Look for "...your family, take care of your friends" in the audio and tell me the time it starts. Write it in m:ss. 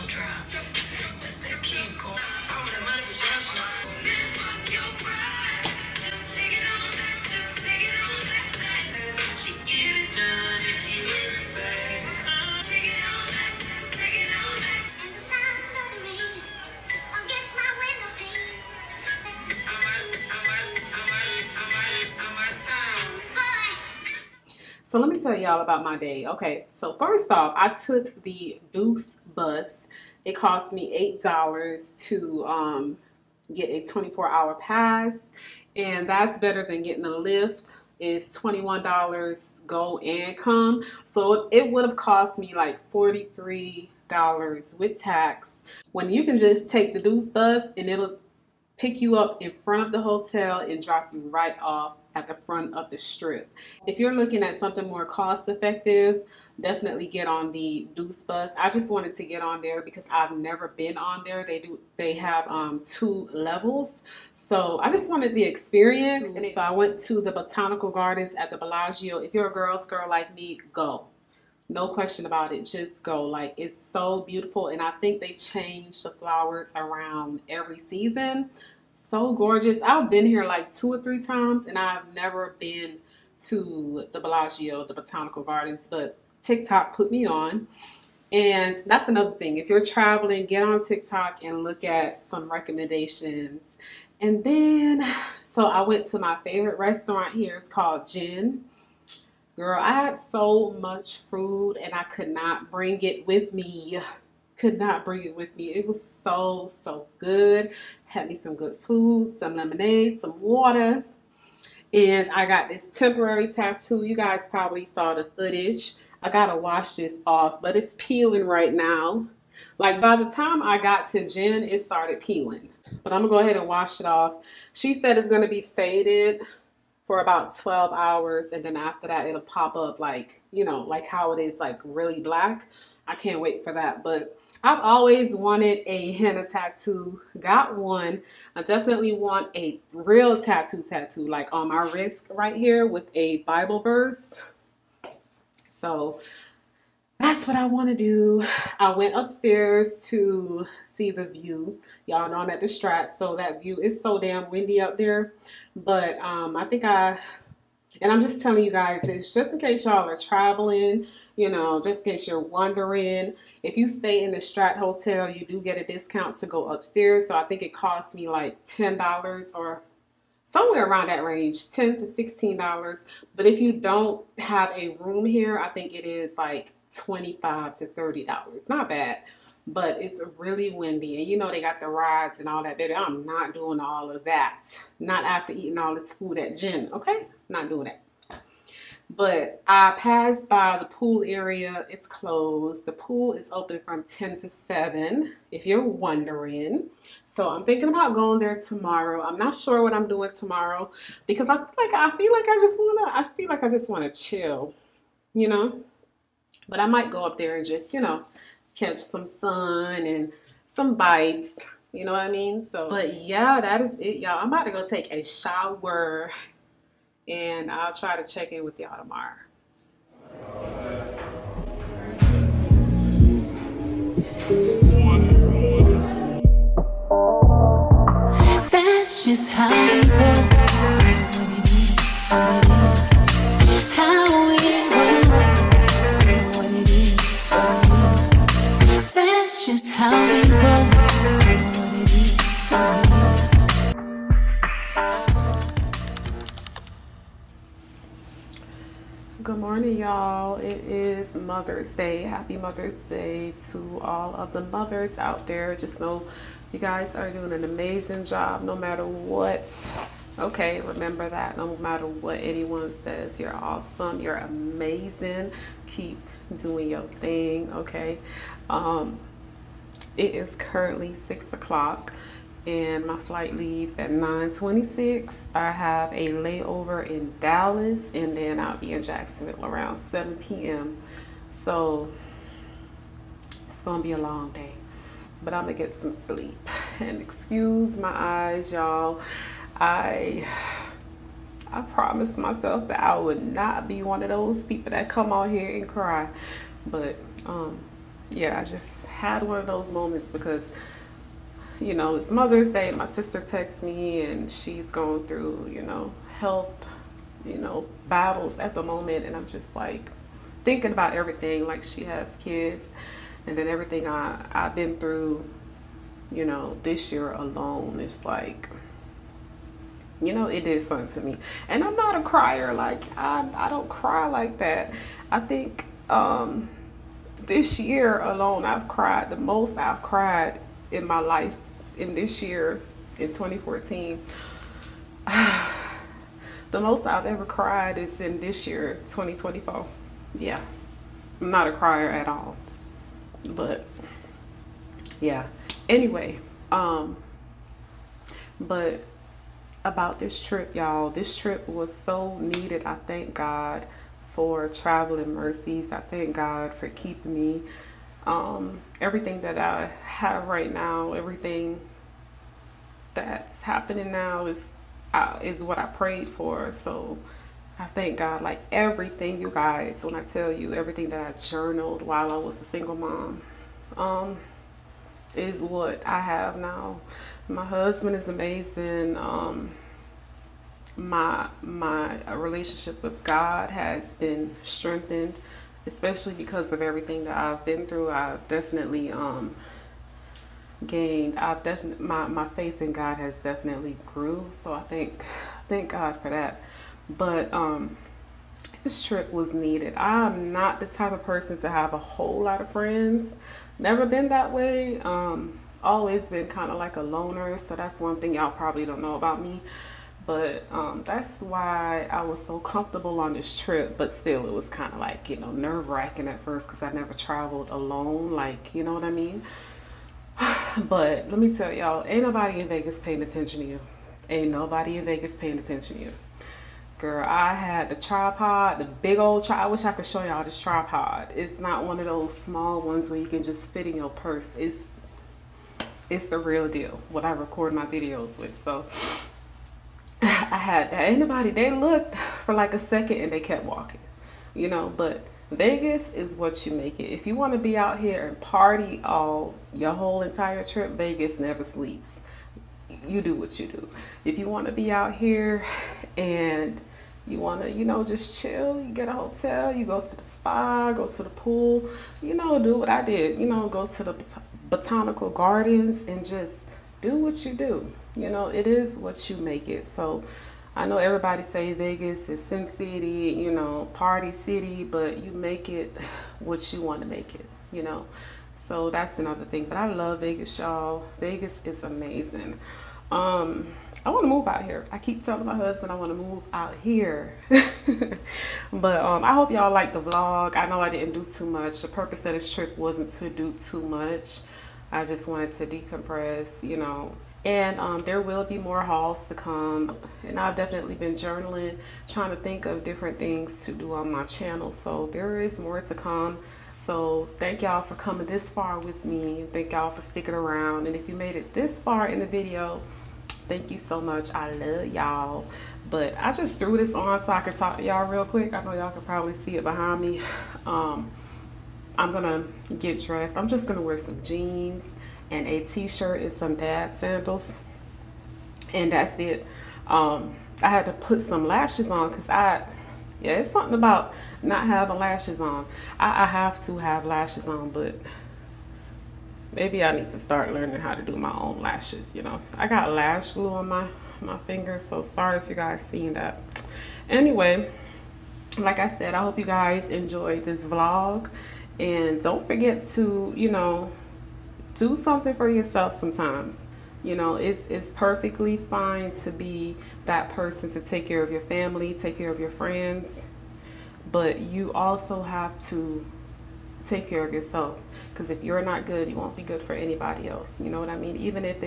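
9:21.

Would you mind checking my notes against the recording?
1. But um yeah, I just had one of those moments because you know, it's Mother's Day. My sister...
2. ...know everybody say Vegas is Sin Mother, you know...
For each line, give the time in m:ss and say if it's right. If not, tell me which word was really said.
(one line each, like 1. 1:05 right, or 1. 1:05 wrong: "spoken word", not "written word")
1. 4:56 right
2. 7:50 wrong: "City", not "Mother".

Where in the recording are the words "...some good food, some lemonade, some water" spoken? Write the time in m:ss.
1:48.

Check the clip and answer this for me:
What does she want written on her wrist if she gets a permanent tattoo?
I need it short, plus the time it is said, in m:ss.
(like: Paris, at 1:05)
a Bible verse, at 2:23.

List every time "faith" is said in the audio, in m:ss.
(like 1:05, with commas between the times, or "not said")
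6:32.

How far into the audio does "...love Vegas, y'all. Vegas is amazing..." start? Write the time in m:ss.
7:59.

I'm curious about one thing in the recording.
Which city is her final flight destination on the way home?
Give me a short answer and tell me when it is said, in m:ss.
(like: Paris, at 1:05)
Jacksonville, at 4:39.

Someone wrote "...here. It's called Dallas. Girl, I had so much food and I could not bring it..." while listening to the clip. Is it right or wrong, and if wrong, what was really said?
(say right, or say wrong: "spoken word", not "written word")
wrong: "Gen", not "Dallas".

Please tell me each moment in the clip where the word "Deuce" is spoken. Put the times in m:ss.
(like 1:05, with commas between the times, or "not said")
0:28, 0:46, 0:57.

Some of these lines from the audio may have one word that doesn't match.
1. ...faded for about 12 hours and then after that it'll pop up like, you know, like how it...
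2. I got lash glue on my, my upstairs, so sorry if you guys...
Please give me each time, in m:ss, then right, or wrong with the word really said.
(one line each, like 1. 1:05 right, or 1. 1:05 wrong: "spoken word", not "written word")
1. 2:05 right
2. 9:02 wrong: "fingers", not "upstairs".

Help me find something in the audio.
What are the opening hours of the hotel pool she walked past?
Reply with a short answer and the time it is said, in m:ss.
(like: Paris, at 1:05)
10 to 7, at 3:14.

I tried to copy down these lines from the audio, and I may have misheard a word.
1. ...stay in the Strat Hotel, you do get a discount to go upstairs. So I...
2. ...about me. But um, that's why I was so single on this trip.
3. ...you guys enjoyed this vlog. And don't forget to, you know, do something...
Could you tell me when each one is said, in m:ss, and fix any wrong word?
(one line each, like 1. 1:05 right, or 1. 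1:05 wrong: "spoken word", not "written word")
1. 2:43 right
2. 6:49 wrong: "comfortable", not "single"
3. 9:09 right.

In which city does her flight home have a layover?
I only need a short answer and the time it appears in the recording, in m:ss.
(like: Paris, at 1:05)
Dallas, at 4:37.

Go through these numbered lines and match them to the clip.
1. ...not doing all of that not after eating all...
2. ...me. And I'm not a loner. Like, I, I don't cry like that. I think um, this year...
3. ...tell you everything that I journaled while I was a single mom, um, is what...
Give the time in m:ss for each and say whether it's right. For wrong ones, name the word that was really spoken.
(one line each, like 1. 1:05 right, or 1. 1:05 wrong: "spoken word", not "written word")
1. 3:03 right
2. 5:21 wrong: "crier", not "loner"
3. 6:10 right.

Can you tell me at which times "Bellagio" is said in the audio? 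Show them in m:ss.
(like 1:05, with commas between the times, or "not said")
1:08, 1:24.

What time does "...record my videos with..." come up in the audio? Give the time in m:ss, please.
7:17.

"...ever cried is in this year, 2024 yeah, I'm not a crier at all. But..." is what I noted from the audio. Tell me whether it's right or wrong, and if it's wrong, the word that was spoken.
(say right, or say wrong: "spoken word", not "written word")
right.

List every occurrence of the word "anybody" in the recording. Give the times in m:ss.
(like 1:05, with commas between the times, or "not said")
7:21, 9:29.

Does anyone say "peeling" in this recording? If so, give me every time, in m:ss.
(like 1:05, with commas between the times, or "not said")
1:57, 2:02.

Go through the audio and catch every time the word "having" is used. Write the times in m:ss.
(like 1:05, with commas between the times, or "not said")
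8:54.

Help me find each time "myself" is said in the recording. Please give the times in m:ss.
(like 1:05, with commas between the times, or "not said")
4:52.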